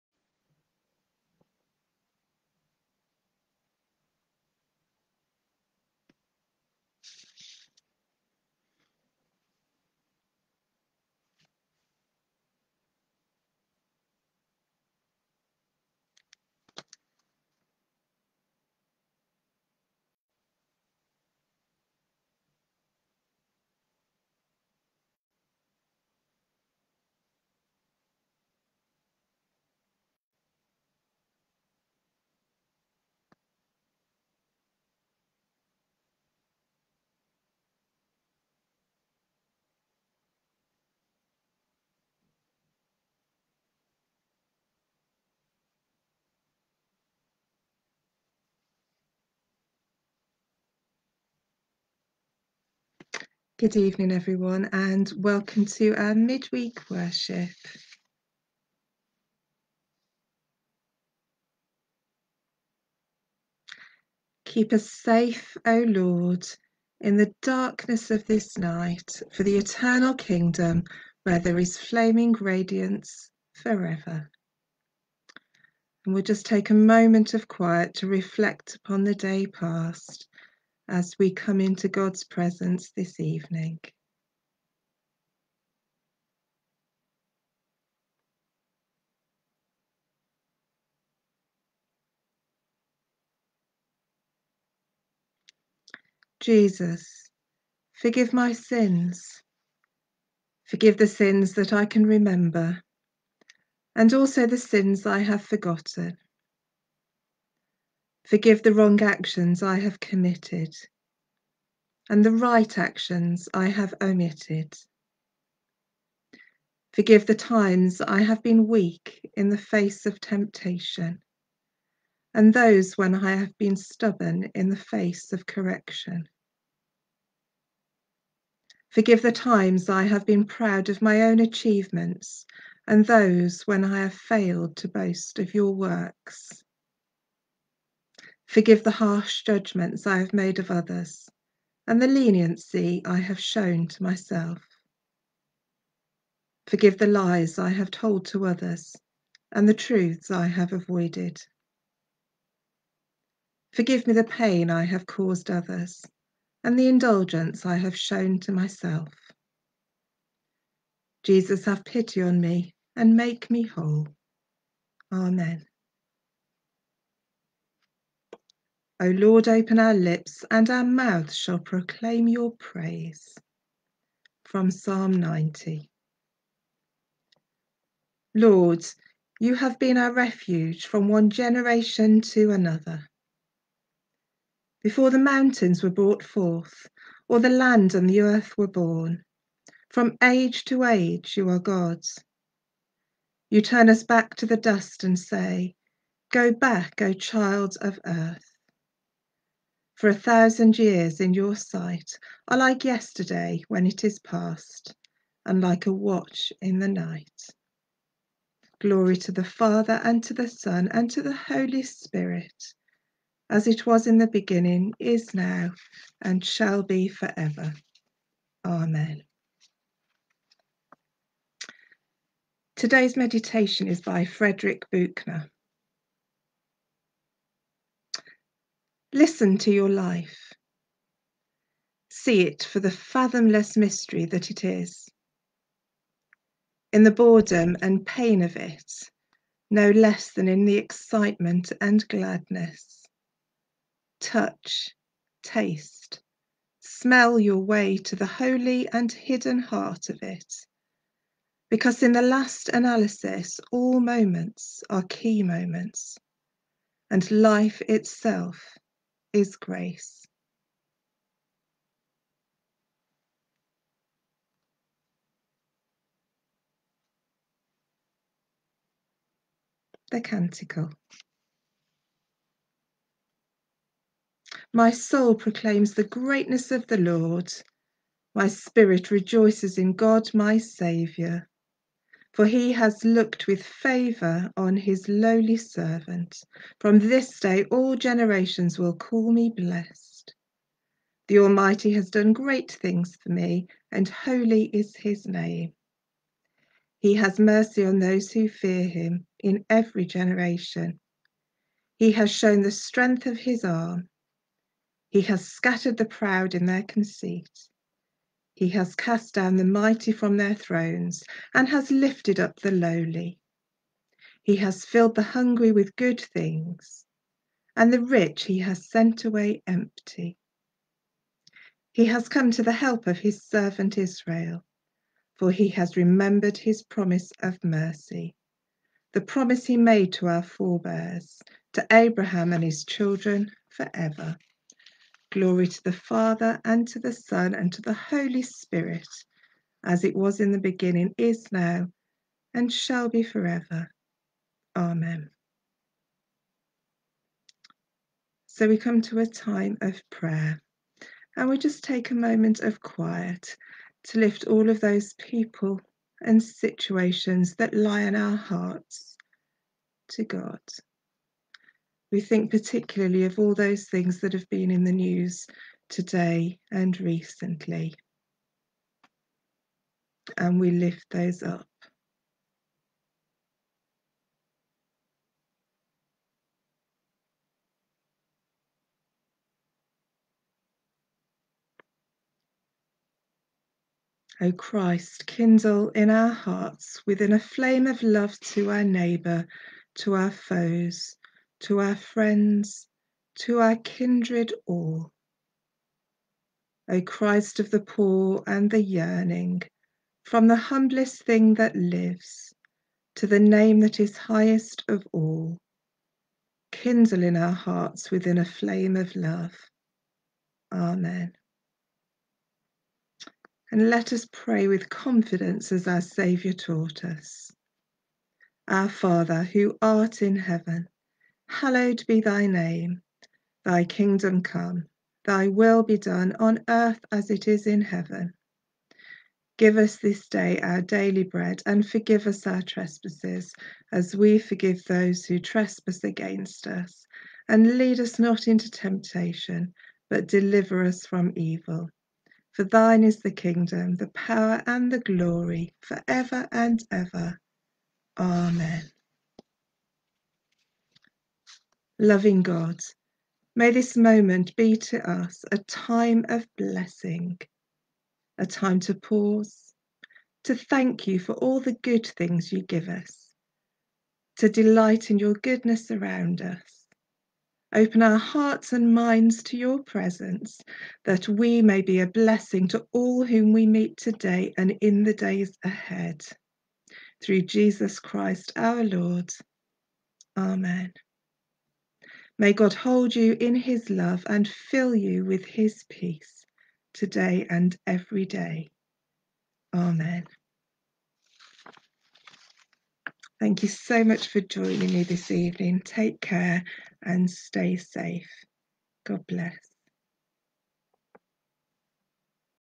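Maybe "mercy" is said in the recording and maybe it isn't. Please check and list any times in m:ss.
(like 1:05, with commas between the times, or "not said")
4:57, 5:27.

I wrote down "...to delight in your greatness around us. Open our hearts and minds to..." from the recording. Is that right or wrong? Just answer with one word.
wrong.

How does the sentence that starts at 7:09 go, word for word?
Give us this day our daily bread and forgive us our trespasses as we forgive those who trespass against us.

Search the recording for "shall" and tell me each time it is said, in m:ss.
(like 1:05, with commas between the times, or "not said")
2:51, 3:36, 5:42.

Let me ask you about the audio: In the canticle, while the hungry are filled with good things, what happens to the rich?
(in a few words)
sent away empty.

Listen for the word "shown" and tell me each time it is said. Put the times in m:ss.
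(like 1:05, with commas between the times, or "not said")
2:23, 2:37, 5:02.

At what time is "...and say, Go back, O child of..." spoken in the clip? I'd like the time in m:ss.
3:15.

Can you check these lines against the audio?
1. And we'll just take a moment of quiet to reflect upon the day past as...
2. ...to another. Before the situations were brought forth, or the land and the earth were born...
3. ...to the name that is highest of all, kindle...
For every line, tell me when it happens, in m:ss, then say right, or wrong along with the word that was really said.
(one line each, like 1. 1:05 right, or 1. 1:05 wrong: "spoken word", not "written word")
1. 1:16 right
2. 3:02 wrong: "mountains", not "situations"
3. 6:43 right.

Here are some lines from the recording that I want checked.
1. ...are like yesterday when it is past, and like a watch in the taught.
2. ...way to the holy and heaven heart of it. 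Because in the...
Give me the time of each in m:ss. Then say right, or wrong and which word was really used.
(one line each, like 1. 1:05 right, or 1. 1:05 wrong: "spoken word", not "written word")
1. 3:22 wrong: "night", not "taught"
2. 4:07 wrong: "hidden", not "heaven".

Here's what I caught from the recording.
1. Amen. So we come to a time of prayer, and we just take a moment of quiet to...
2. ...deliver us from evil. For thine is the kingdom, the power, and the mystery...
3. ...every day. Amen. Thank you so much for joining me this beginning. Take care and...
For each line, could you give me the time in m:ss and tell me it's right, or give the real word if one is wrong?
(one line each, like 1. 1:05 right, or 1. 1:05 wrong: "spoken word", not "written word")
1. 5:44 right
2. 7:20 wrong: "glory", not "mystery"
3. 8:07 wrong: "evening", not "beginning".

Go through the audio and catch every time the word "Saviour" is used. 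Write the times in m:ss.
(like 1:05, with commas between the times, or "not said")
4:40, 6:56.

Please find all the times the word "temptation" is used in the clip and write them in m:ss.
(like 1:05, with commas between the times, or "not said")
2:00, 7:18.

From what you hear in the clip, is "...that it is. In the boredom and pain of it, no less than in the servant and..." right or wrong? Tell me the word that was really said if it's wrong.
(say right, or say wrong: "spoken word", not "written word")
wrong: "excitement", not "servant".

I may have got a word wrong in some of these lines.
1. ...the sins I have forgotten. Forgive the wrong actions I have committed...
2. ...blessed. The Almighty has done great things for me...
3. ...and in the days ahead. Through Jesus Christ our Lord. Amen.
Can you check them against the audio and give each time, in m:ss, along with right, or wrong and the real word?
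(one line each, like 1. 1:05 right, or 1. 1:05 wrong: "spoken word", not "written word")
1. 1:44 right
2. 4:49 right
3. 7:54 right.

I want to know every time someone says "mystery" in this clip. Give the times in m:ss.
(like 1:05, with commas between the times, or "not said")
3:53.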